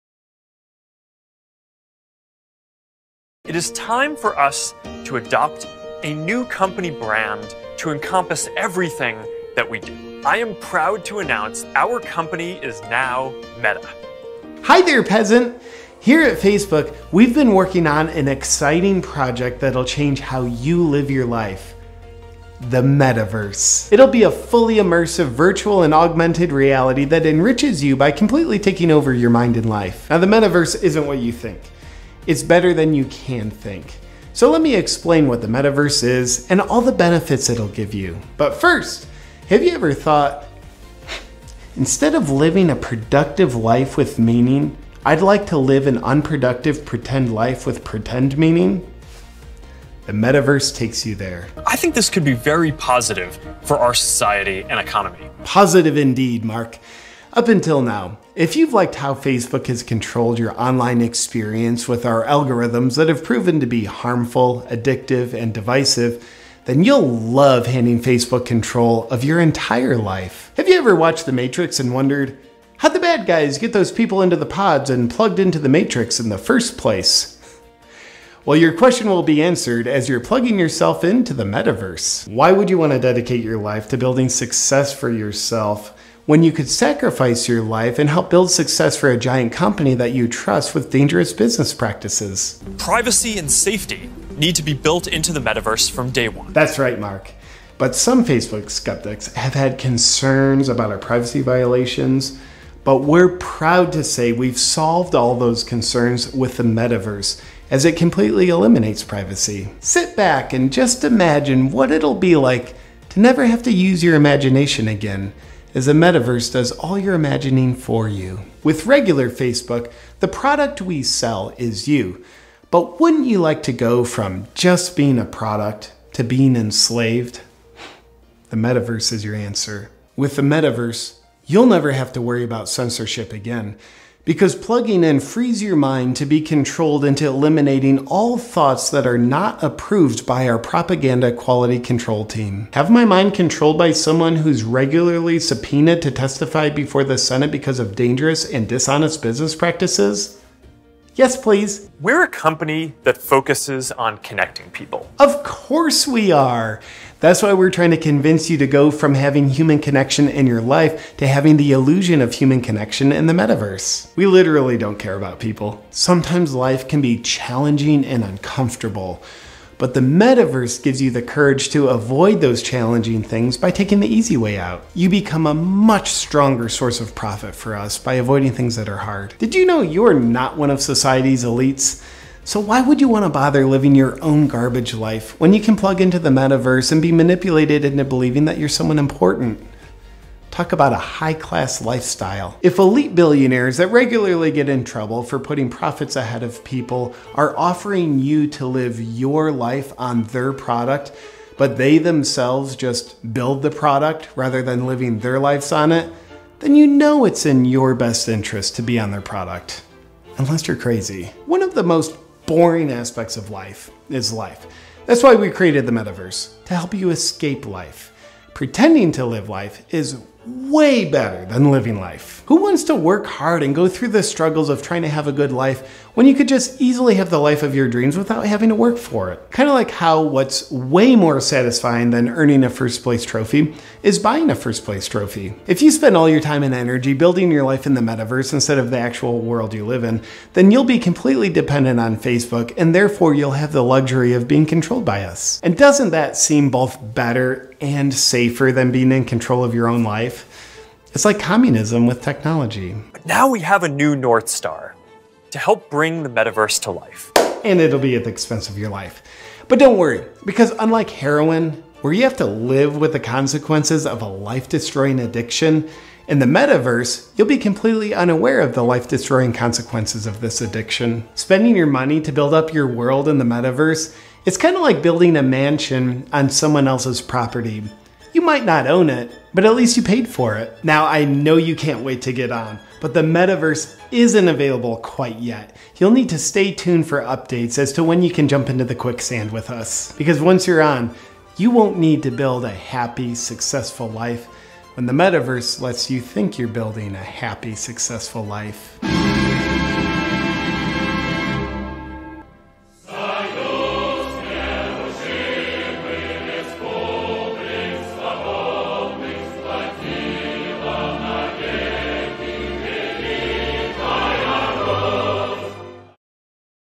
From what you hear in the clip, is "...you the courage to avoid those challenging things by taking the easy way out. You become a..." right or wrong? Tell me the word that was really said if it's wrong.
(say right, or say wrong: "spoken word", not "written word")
right.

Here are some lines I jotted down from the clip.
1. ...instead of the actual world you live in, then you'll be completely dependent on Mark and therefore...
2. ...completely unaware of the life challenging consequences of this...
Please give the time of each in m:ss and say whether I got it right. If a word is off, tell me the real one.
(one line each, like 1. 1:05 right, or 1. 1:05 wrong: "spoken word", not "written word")
1. 3:58 wrong: "Facebook", not "Mark"
2. 4:27 wrong: "destroying", not "challenging".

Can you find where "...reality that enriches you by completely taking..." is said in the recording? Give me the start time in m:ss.
0:26.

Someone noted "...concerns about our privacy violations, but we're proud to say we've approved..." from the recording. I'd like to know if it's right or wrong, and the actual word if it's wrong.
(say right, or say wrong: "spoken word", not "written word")
wrong: "solved", not "approved".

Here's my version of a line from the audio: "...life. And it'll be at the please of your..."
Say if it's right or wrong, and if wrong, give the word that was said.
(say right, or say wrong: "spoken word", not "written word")
wrong: "expense", not "please".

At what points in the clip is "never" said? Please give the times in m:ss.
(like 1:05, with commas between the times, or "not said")
1:53, 2:11.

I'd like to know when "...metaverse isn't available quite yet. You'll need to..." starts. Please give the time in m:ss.
4:43.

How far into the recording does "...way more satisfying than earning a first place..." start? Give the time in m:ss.
3:50.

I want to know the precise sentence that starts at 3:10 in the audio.
Talk about a high class lifestyle.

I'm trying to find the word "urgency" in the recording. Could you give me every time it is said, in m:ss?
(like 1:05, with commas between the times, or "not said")
not said.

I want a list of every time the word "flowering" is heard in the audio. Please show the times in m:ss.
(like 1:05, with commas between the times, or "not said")
not said.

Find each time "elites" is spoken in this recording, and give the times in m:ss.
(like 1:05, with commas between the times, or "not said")
3:01, 3:12.